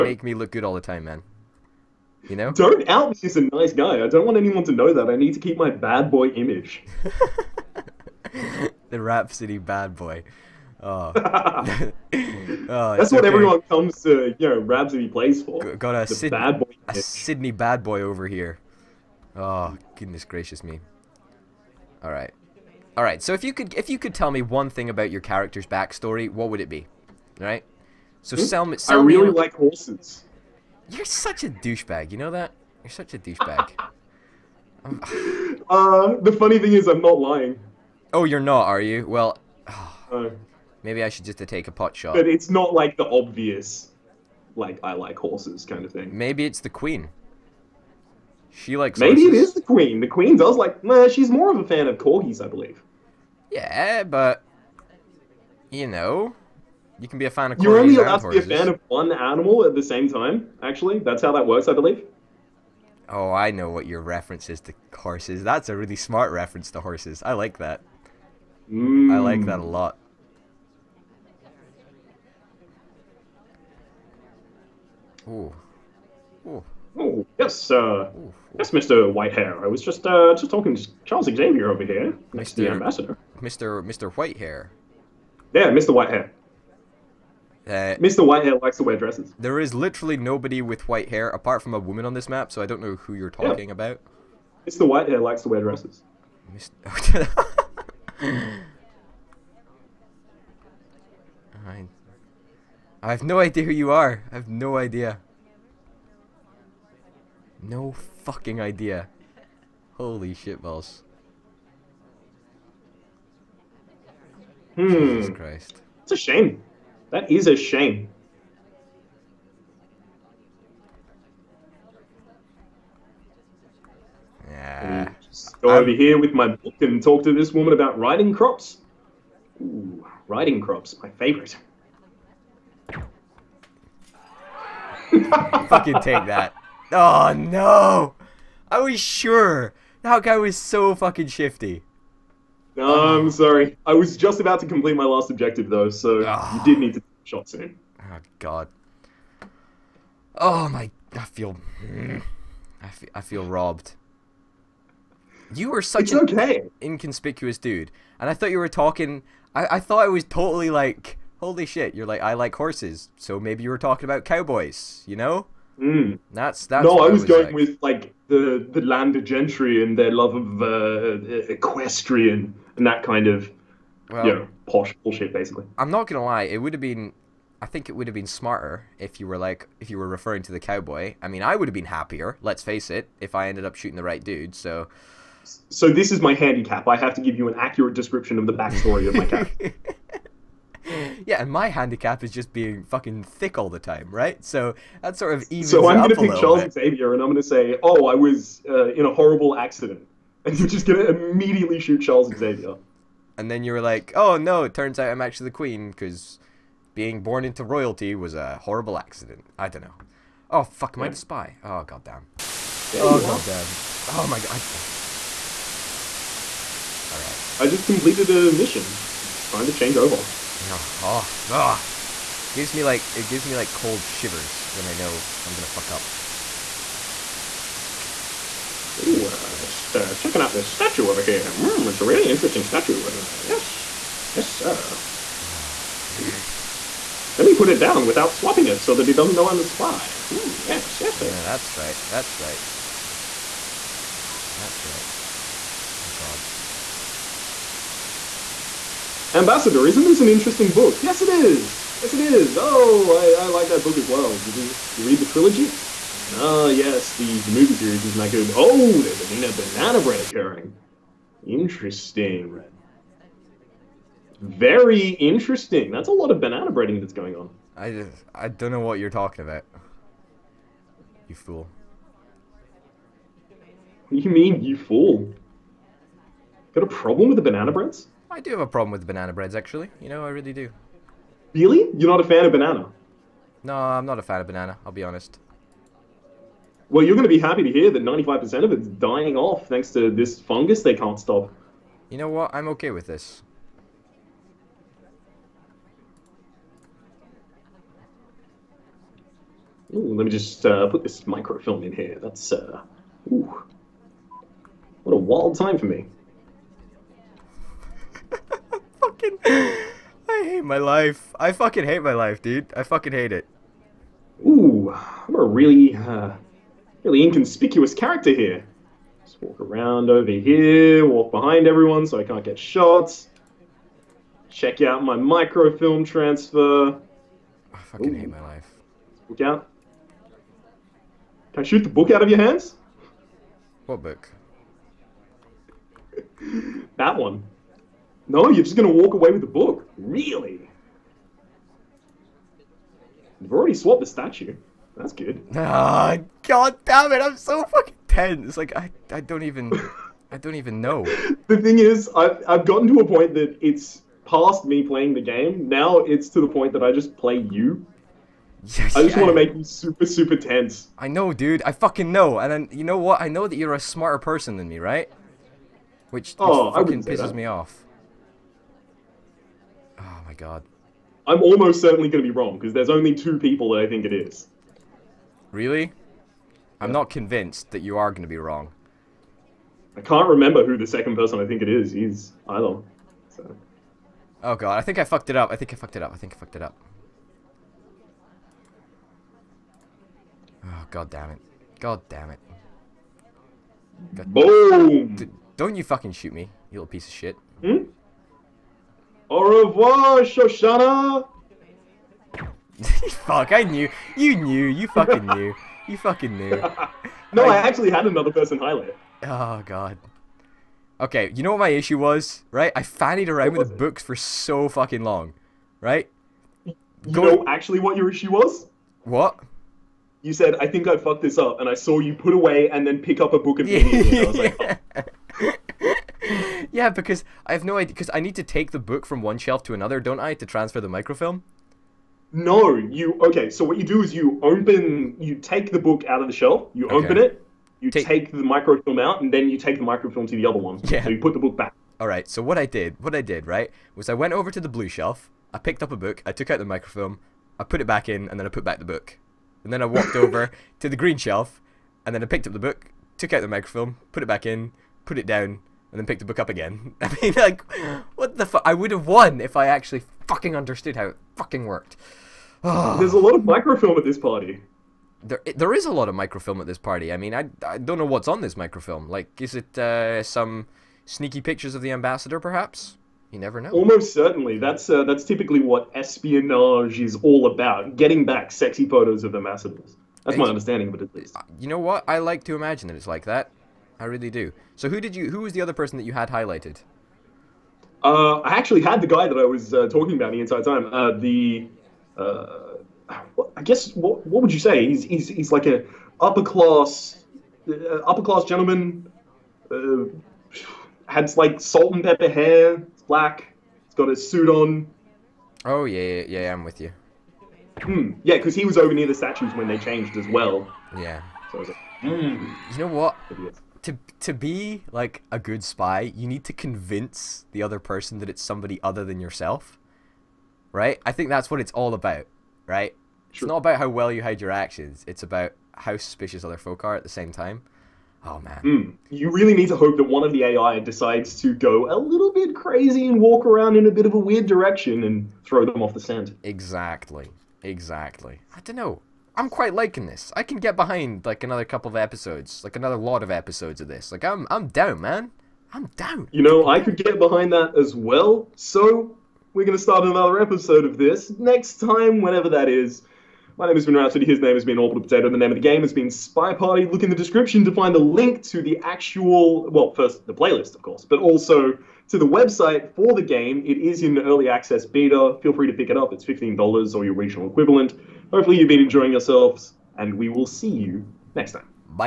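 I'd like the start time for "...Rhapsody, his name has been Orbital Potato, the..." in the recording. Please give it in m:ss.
9:13.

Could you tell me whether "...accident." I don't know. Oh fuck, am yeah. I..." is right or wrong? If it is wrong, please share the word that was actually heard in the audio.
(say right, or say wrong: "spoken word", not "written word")
right.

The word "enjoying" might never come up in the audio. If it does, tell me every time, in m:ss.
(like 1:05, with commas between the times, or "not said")
9:28.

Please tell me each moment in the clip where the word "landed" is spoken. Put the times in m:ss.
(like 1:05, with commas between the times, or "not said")
2:48.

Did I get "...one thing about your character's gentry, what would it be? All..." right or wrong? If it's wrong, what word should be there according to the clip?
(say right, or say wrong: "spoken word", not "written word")
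wrong: "backstory", not "gentry".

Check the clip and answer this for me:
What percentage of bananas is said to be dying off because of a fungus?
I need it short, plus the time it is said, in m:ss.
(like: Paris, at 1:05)
95%, at 4:48.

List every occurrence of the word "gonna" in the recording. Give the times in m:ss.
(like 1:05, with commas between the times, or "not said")
2:56, 3:45, 9:09.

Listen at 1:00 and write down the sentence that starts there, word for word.
Actually, that's how that works, I believe.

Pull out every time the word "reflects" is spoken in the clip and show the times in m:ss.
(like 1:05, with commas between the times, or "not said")
not said.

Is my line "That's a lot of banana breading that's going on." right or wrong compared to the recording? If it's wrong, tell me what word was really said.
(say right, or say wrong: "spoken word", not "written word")
right.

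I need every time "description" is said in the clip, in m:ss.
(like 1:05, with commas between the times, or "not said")
3:07, 9:17.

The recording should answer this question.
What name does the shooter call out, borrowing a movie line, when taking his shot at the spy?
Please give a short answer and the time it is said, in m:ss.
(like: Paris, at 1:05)
Shosanna, at 6:39.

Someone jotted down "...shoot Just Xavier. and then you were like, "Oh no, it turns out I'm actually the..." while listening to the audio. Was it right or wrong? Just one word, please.
wrong.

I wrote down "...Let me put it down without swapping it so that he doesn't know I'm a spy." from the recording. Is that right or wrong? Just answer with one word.
right.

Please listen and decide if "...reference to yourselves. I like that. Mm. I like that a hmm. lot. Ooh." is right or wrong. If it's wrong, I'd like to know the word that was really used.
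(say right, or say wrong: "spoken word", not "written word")
wrong: "horses", not "yourselves".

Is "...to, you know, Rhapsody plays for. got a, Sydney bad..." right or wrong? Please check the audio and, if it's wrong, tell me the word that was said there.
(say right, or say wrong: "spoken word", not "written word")
right.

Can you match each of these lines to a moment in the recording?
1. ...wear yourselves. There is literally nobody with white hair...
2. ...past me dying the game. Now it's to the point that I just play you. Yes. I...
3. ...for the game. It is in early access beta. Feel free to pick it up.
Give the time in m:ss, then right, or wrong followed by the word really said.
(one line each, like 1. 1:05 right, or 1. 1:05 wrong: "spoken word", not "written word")
1. 1:28 wrong: "dresses", not "yourselves"
2. 5:54 wrong: "playing", not "dying"
3. 9:22 right.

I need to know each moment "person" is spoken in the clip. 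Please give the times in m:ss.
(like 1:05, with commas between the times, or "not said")
6:04, 6:21, 6:48, 8:05, 8:37.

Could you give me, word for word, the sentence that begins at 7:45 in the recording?
There, there is a lot of microfilm at this party.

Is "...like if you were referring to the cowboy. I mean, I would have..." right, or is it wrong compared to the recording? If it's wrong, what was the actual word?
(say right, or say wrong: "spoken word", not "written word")
right.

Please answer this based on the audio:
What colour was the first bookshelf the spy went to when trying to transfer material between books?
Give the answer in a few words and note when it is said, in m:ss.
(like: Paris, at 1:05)
Blue, at 7:24.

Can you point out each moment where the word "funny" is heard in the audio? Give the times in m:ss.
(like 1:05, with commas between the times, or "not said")
0:36.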